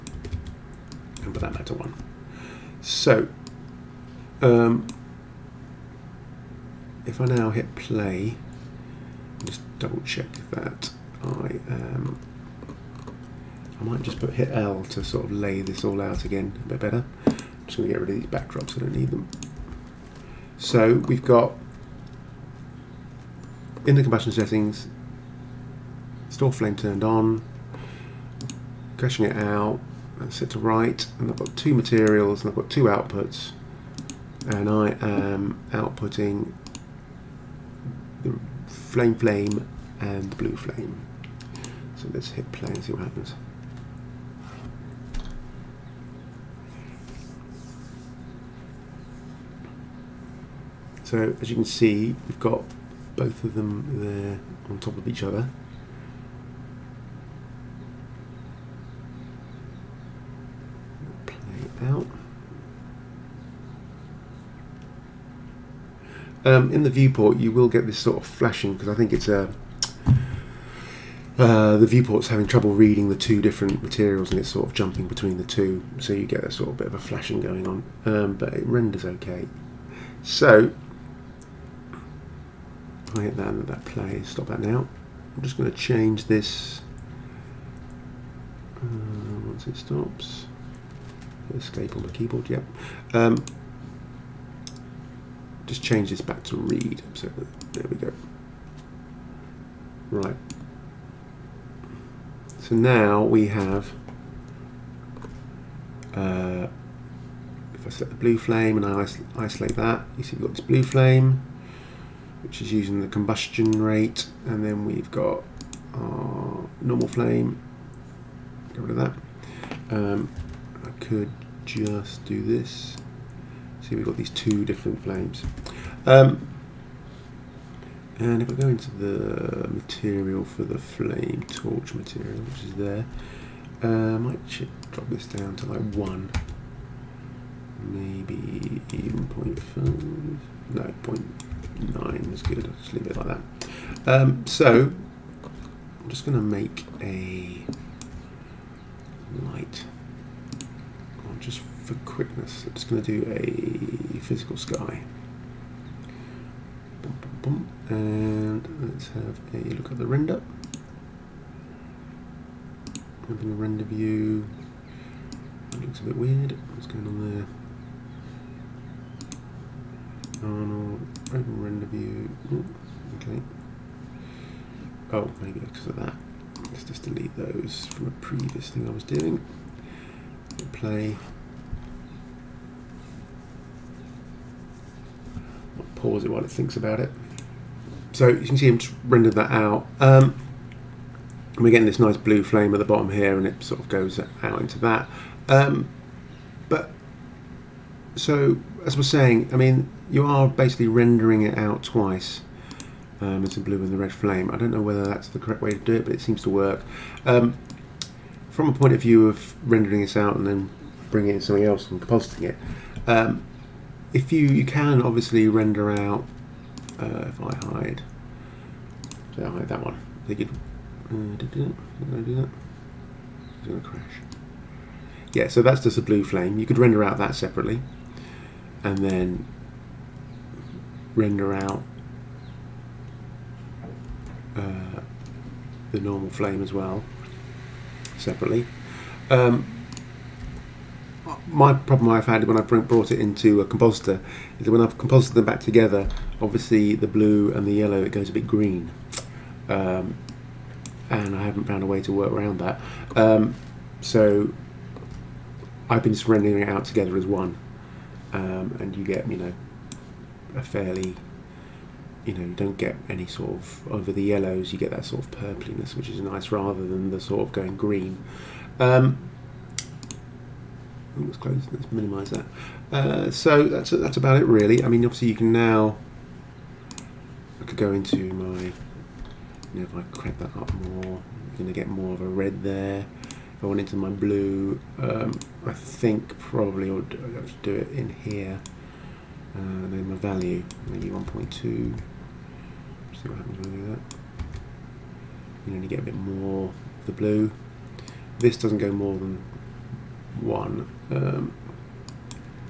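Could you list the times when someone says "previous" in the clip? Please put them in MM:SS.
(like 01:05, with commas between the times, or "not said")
02:58.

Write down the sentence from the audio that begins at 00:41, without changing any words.
So let's hit play and see what happens.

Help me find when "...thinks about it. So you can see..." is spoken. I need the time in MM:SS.
03:06.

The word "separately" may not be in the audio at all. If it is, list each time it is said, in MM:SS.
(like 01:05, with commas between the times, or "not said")
03:47, 03:58.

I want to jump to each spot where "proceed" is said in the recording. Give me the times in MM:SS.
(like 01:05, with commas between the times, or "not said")
not said.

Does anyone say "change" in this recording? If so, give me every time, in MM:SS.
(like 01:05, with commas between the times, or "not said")
01:25, 01:35.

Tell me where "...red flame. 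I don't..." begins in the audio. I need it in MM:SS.
03:23.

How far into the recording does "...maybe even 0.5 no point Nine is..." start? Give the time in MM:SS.
02:17.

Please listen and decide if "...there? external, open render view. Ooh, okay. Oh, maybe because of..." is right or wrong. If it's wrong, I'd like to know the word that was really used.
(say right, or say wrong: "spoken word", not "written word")
right.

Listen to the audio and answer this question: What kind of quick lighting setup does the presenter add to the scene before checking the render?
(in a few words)
Physical sky.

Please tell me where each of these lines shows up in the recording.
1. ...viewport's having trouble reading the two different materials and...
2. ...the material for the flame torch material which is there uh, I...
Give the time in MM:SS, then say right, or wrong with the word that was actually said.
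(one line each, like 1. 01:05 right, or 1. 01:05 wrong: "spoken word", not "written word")
1. 01:11 right
2. 02:08 right.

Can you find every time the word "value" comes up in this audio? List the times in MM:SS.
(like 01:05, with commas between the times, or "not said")
04:50.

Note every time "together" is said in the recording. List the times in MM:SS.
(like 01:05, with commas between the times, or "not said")
04:05, 04:16.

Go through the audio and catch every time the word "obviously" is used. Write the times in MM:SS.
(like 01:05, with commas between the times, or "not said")
03:35, 04:06, 04:35.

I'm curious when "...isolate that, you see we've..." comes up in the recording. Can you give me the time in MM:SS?
01:49.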